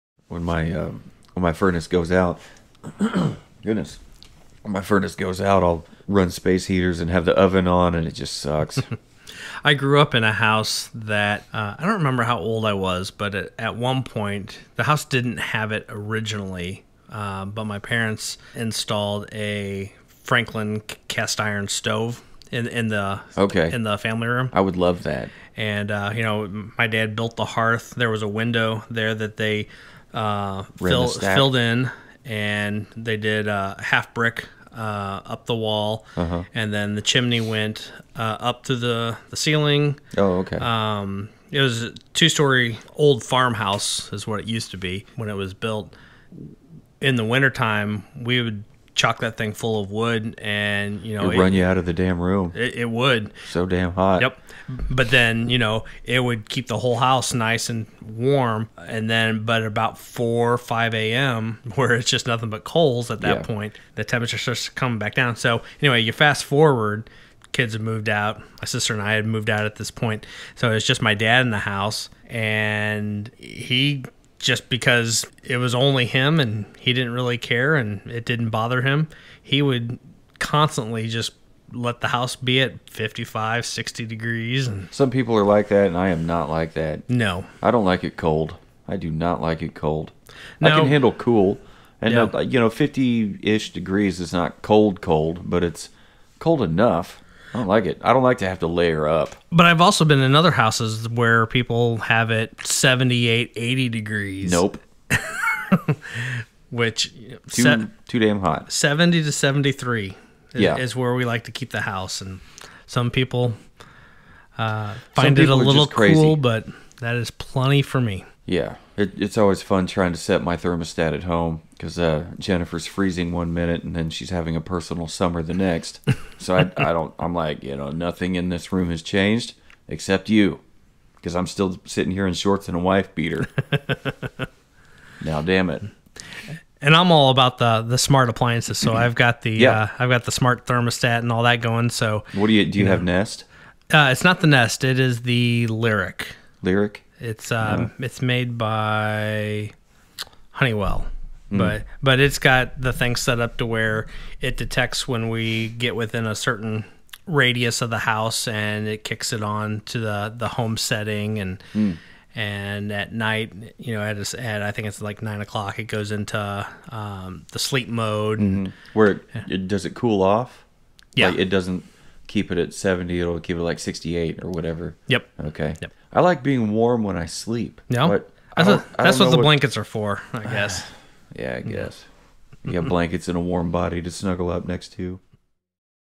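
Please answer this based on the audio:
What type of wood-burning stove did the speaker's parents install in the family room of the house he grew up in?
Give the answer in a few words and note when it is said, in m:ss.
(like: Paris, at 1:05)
Franklin cast iron stove, at 0:20.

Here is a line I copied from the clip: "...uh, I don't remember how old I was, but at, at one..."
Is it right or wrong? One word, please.
right.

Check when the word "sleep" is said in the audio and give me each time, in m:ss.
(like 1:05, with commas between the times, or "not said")
2:47, 2:57.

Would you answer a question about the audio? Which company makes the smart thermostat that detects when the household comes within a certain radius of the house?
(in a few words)
Honeywell.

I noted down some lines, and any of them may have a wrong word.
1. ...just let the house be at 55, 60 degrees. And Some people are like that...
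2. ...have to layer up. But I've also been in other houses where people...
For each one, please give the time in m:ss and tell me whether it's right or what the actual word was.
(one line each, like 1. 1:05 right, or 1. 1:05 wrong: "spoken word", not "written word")
1. 1:21 right
2. 1:38 right.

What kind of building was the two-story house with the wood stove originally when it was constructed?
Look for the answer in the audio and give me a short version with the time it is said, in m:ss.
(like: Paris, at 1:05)
farmhouse, at 0:43.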